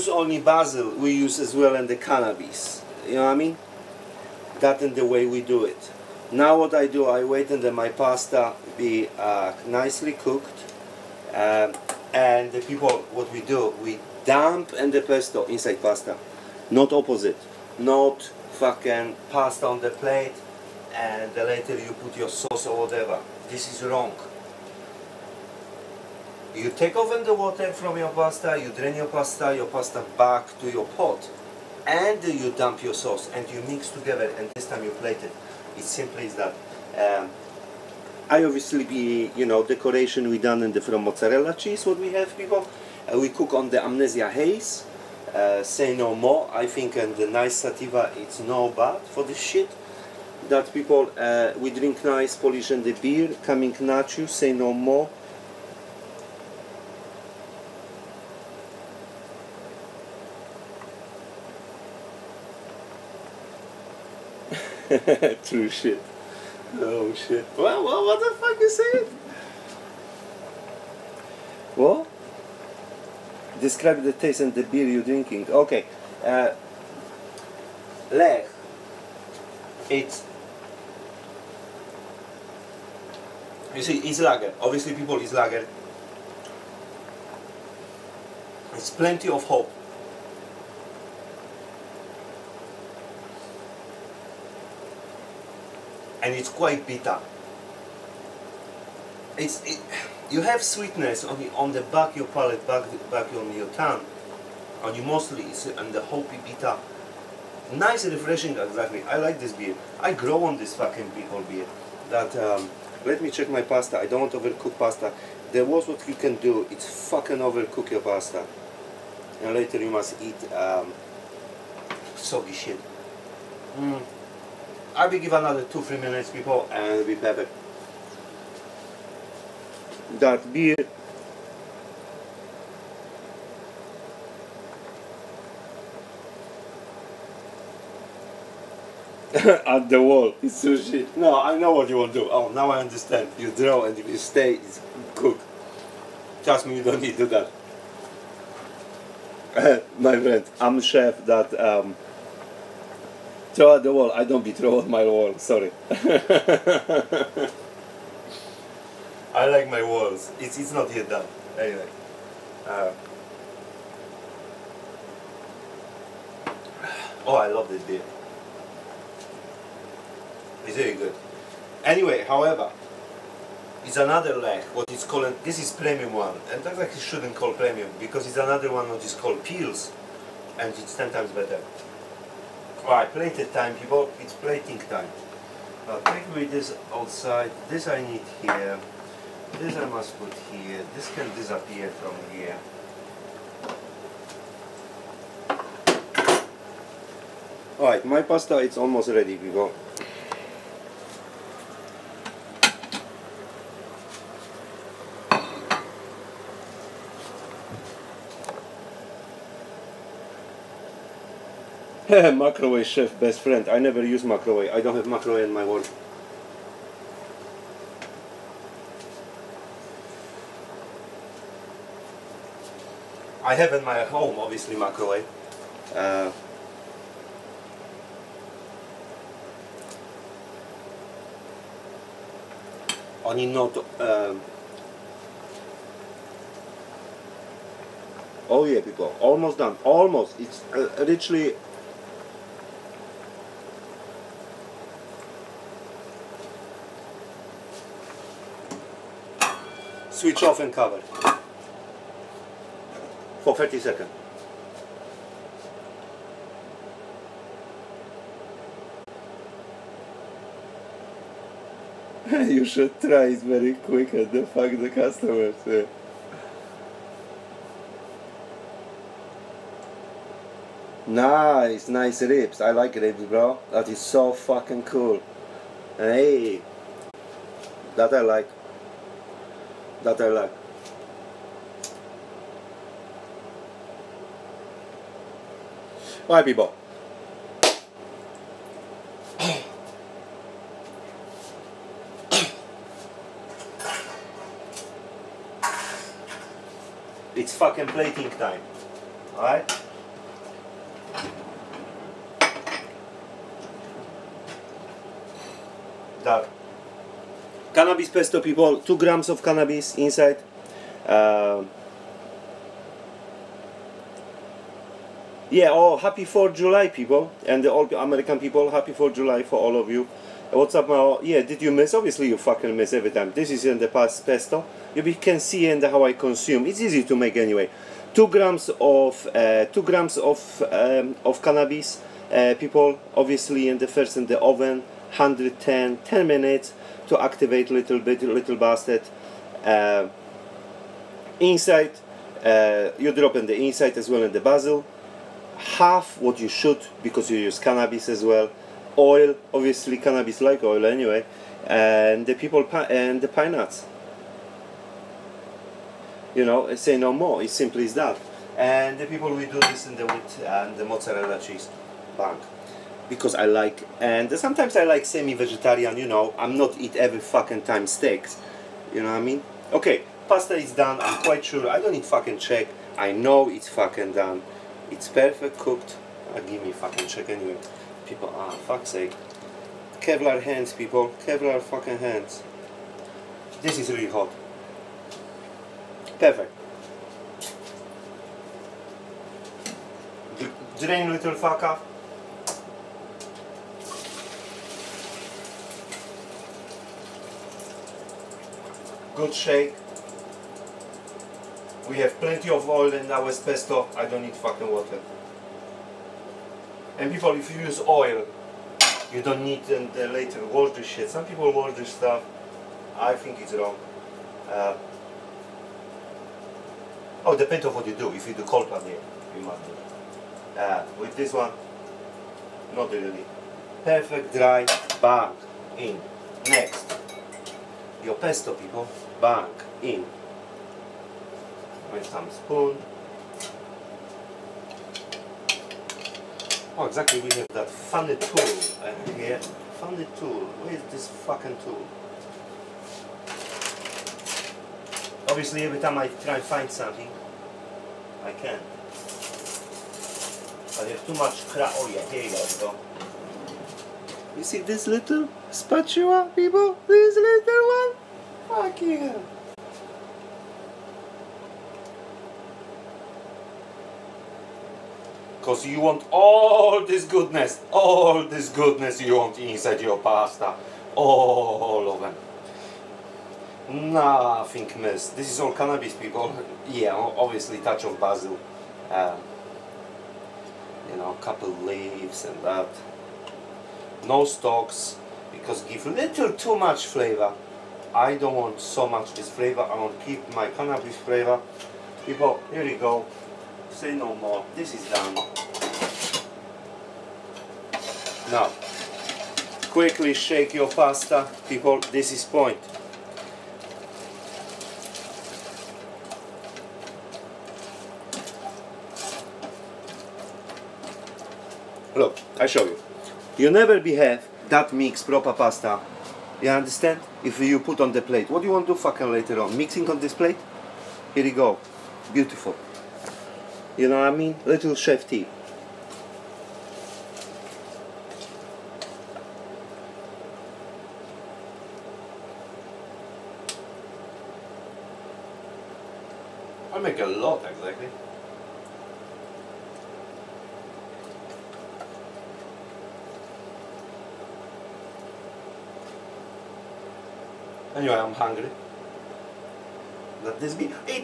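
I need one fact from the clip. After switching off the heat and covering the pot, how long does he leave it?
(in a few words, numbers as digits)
30 seconds.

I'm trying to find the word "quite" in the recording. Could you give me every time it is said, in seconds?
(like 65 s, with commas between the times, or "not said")
96 s, 371 s.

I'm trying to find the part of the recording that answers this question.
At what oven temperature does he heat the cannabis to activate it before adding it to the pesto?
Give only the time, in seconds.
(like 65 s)
335 s.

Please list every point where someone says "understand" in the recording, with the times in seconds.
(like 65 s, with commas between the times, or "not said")
142 s, 516 s.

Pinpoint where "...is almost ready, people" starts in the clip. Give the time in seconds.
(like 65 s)
198 s.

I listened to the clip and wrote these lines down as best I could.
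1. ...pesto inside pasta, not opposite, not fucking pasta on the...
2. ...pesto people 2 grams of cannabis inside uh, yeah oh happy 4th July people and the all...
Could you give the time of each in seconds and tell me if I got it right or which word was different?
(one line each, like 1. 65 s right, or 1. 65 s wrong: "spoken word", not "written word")
1. 15 s right
2. 308 s right.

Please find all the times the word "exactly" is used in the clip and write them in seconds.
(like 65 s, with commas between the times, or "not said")
108 s, 436 s.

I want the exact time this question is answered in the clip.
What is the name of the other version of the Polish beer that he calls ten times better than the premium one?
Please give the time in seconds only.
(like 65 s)
179 s.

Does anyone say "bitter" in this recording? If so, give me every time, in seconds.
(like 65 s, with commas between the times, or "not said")
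96 s, 106 s.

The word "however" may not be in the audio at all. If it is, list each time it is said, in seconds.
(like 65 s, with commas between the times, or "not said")
172 s.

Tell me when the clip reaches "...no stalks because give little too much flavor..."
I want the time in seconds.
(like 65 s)
484 s.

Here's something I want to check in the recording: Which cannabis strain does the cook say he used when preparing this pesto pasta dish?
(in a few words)
Amnesia Haze.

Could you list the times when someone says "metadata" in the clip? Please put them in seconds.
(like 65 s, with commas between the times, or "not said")
not said.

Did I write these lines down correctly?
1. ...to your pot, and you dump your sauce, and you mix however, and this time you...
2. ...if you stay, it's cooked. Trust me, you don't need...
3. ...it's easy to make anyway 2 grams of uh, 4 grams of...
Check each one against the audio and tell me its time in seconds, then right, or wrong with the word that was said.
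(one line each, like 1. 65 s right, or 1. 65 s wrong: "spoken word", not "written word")
1. 30 s wrong: "together", not "however"
2. 143 s right
3. 326 s wrong: "2", not "4".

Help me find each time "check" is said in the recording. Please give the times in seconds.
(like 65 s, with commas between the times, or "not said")
113 s, 372 s, 377 s.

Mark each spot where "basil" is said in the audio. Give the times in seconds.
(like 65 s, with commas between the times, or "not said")
0 s, 344 s, 477 s.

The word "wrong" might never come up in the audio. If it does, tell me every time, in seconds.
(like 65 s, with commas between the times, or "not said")
23 s, 413 s.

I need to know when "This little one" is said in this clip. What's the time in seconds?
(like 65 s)
456 s.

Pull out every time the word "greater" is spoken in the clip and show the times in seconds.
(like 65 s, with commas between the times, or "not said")
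not said.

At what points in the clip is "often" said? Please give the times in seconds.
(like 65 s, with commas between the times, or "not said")
not said.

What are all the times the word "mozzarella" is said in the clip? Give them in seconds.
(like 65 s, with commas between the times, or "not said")
41 s, 360 s.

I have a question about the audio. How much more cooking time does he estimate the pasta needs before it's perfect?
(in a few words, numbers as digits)
2-3 minutes.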